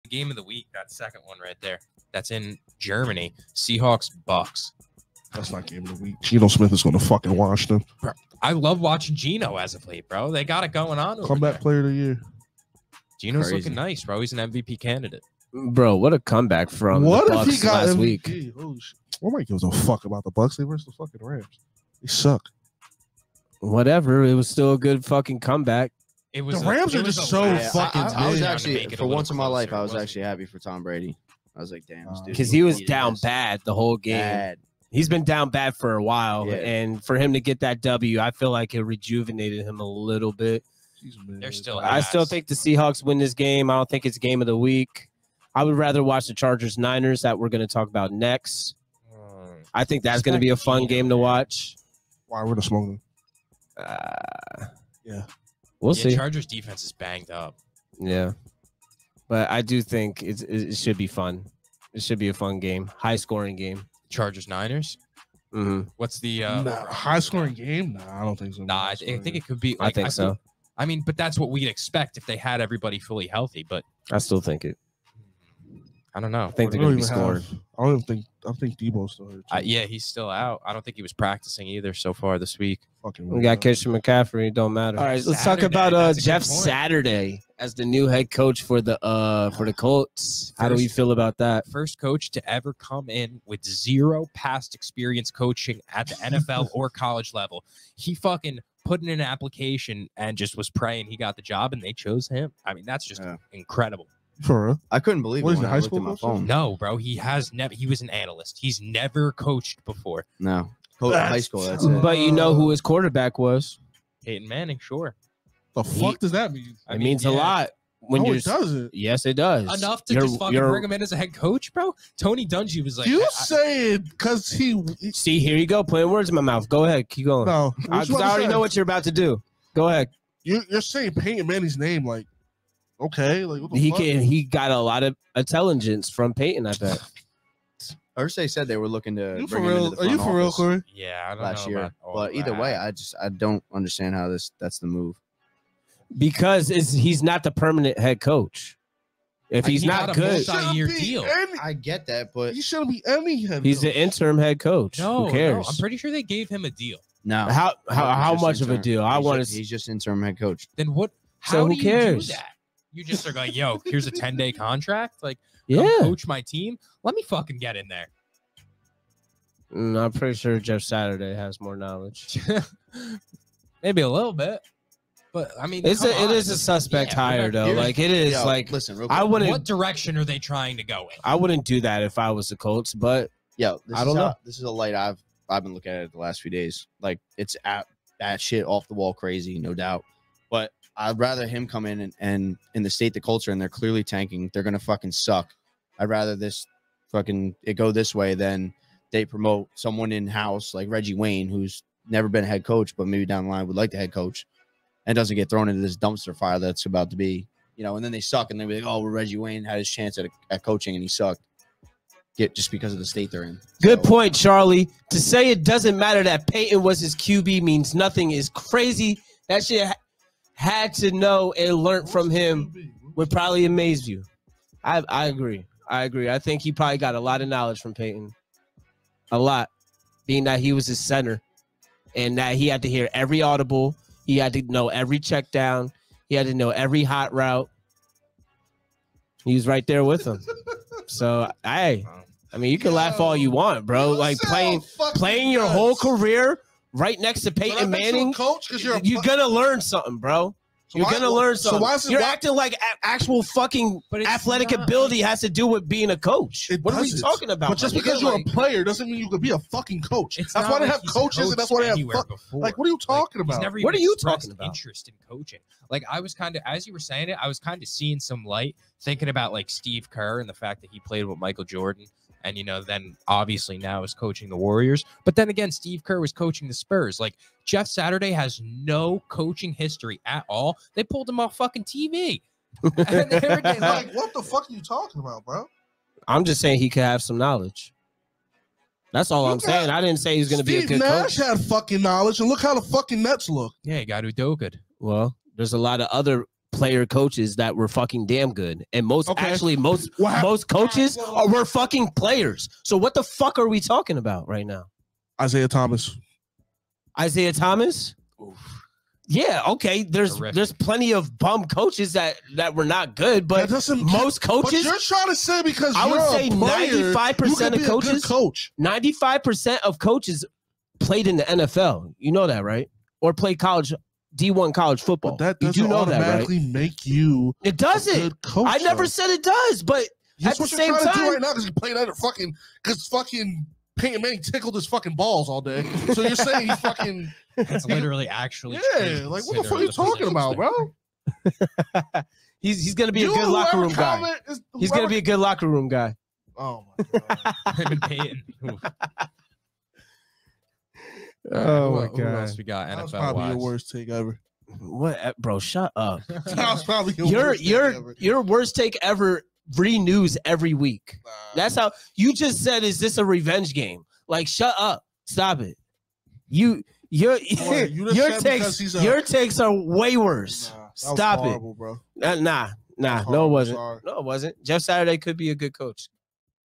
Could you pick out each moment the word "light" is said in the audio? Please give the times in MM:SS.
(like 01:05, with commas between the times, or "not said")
03:04, 04:28.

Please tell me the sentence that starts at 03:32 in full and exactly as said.
Get just because of the state they're in.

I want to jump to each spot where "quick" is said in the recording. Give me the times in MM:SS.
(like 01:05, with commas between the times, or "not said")
02:59.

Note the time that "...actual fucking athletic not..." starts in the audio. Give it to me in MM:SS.
04:13.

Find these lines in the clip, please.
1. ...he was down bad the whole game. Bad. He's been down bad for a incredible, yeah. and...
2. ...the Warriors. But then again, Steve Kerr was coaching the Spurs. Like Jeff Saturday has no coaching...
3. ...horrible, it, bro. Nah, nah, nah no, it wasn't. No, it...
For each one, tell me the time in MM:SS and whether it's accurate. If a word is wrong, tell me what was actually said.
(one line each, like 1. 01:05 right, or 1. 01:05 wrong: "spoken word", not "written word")
1. 00:32 wrong: "while", not "incredible"
2. 04:34 right
3. 06:11 right.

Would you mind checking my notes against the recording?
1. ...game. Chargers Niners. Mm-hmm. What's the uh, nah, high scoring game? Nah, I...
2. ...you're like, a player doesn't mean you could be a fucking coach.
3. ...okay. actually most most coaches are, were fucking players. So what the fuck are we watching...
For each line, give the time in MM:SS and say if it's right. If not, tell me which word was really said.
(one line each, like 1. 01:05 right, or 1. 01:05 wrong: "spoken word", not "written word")
1. 01:03 right
2. 04:18 right
3. 04:59 wrong: "talking", not "watching".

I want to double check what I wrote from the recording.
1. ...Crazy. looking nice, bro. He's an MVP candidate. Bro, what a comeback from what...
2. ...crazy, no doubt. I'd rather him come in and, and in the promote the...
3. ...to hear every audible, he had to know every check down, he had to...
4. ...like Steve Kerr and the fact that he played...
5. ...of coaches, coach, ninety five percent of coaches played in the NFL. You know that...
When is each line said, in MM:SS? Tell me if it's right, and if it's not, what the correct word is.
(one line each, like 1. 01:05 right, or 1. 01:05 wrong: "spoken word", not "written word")
1. 00:13 right
2. 03:09 wrong: "state", not "promote"
3. 03:52 right
4. 04:29 right
5. 05:17 right.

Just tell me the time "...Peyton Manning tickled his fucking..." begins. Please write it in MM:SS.
05:33.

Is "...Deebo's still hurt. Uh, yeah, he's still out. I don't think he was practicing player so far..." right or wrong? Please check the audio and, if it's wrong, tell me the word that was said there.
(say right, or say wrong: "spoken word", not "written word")
wrong: "either", not "player".